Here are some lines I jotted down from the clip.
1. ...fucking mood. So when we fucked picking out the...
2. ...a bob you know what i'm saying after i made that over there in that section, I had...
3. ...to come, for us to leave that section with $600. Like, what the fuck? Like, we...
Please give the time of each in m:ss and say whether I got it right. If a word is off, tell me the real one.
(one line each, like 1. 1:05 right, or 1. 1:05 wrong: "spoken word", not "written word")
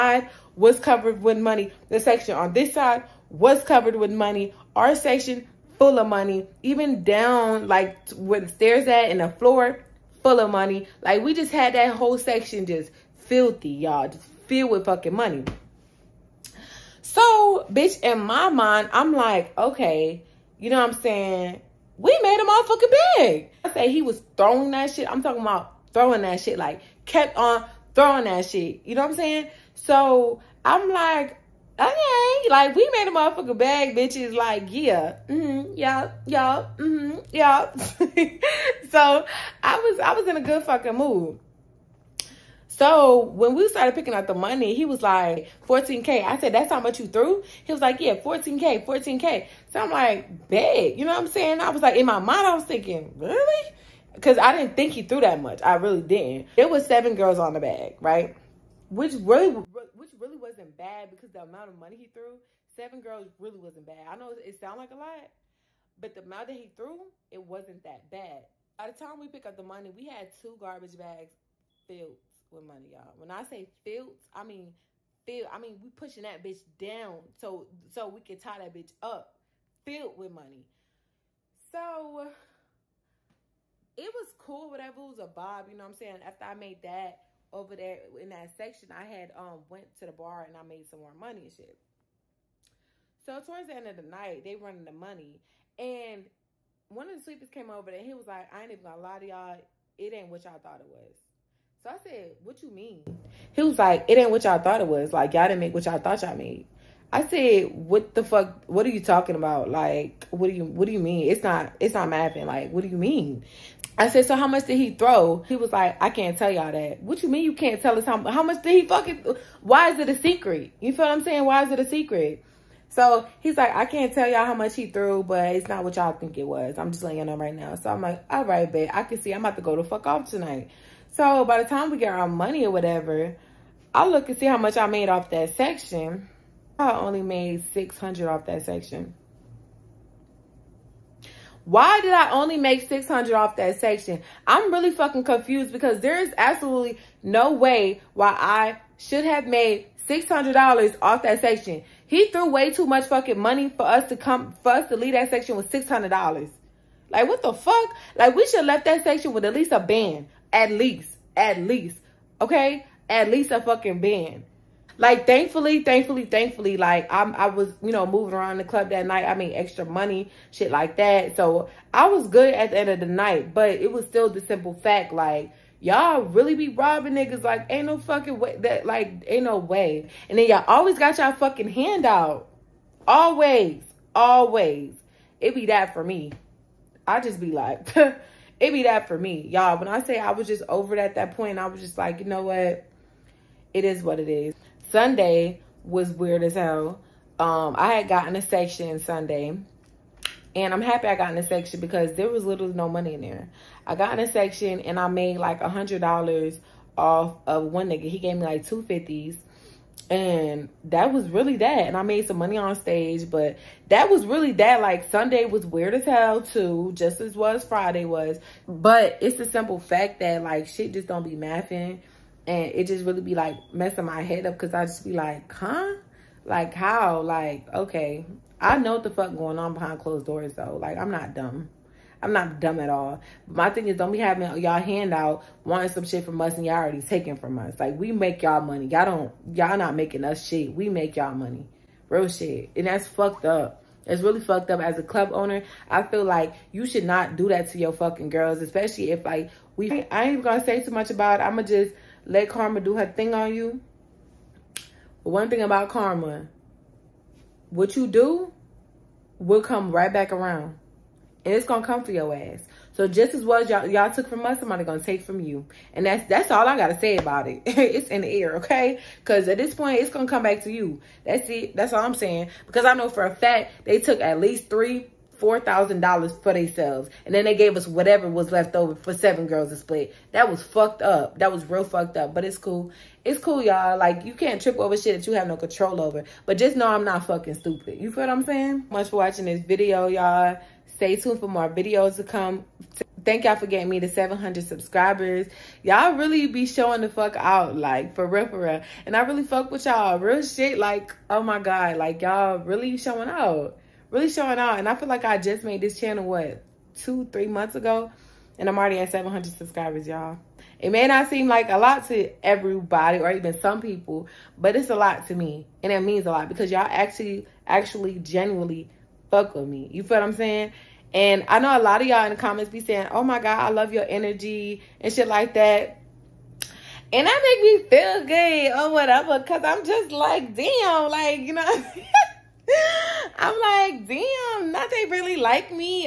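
1. 0:40 wrong: "started", not "fucked"
2. 1:25 right
3. 2:34 right.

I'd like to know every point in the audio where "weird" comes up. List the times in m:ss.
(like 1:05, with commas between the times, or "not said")
3:16, 3:35.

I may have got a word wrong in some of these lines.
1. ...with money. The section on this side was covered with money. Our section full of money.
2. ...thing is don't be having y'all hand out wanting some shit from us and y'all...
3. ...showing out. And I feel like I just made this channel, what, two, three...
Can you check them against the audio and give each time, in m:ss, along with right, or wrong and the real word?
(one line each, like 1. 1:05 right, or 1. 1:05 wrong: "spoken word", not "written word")
1. 0:01 right
2. 3:53 right
3. 5:04 right.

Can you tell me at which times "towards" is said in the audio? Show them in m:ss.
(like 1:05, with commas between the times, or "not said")
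1:33.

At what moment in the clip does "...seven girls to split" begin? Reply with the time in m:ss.
4:39.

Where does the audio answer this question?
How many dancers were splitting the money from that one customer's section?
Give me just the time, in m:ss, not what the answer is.
0:56.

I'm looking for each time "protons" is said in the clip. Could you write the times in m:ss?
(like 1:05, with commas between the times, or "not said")
not said.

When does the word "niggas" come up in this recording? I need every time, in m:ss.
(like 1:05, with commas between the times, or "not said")
2:57, 3:27.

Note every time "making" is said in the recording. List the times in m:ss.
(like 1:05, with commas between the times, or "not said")
3:59.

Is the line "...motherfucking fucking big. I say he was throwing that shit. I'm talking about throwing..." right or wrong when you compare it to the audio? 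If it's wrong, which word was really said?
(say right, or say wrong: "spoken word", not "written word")
right.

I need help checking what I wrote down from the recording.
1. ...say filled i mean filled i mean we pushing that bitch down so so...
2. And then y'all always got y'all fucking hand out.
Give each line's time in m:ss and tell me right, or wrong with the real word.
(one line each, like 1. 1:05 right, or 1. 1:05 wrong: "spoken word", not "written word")
1. 1:13 right
2. 3:00 right.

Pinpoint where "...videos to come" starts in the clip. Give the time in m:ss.
4:51.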